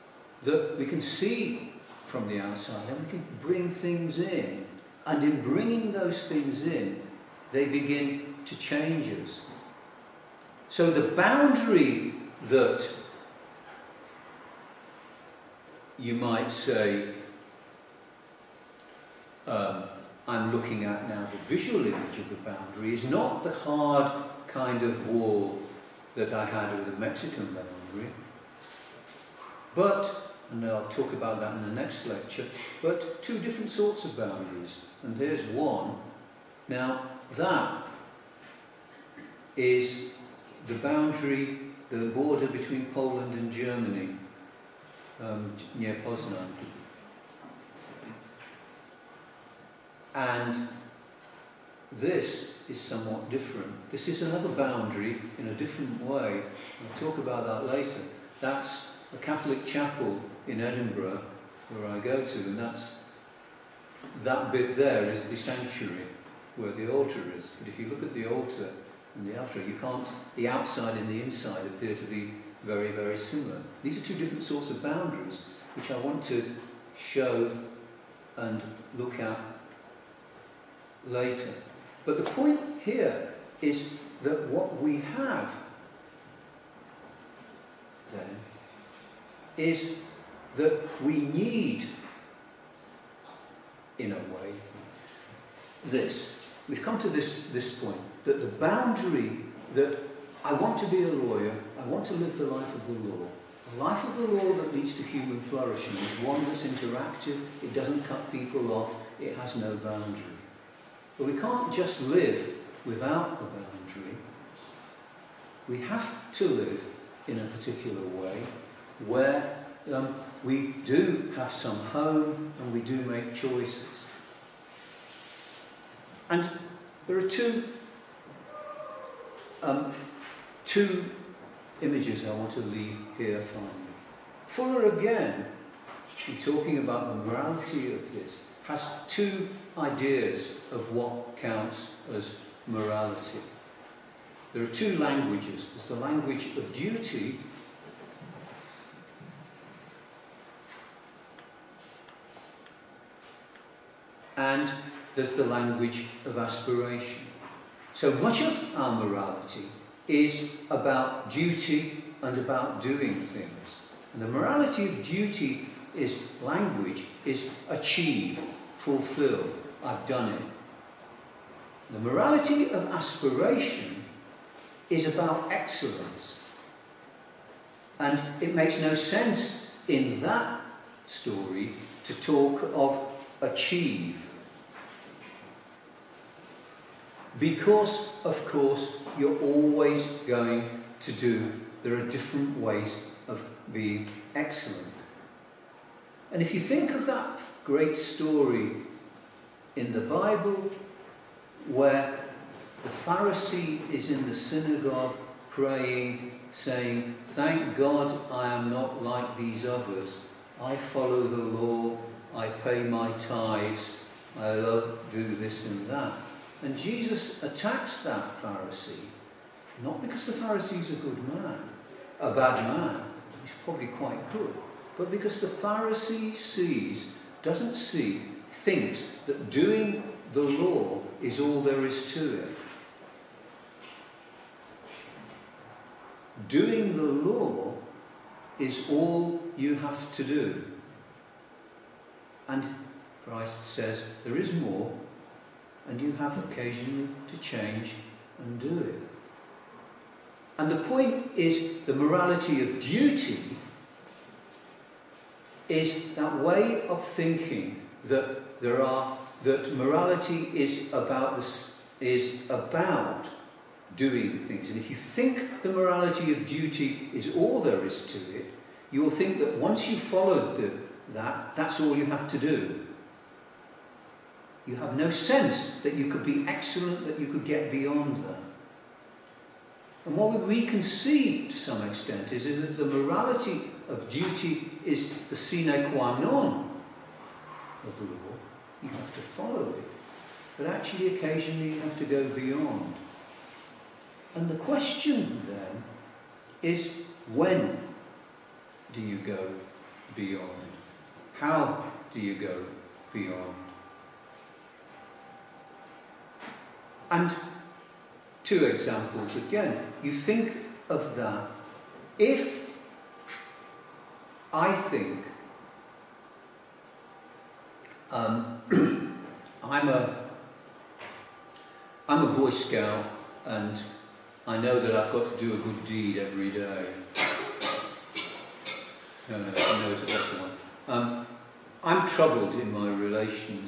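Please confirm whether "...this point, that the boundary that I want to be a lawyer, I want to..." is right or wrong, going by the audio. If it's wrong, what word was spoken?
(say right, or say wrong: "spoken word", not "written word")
right.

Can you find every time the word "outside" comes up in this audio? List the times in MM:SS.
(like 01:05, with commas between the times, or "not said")
00:02, 01:10.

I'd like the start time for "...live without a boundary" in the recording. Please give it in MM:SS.
01:52.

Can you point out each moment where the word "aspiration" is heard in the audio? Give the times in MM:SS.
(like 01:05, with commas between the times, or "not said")
02:36, 02:52.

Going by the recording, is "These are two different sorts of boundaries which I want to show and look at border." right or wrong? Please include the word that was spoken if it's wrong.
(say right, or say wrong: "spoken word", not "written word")
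wrong: "later", not "border".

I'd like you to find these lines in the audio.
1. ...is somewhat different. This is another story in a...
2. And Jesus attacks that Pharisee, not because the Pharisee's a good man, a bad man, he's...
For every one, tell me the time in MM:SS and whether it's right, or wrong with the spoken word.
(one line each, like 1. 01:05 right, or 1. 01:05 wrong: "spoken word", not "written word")
1. 00:52 wrong: "boundary", not "story"
2. 03:36 right.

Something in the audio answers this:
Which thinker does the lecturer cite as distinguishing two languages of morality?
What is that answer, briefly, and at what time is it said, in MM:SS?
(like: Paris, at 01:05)
Fuller, at 02:14.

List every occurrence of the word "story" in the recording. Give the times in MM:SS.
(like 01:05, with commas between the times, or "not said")
03:01, 03:17.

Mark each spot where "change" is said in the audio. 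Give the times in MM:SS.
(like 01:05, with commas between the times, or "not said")
00:08, 04:07.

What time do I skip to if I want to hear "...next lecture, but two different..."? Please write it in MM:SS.
00:31.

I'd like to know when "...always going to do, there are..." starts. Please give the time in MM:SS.
03:09.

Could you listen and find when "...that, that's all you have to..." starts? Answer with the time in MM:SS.
04:31.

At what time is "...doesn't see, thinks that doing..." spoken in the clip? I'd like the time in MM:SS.
03:47.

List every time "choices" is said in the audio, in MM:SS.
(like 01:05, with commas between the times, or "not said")
02:03.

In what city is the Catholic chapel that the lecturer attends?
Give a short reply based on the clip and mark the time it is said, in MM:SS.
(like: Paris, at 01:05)
Edinburgh, at 01:00.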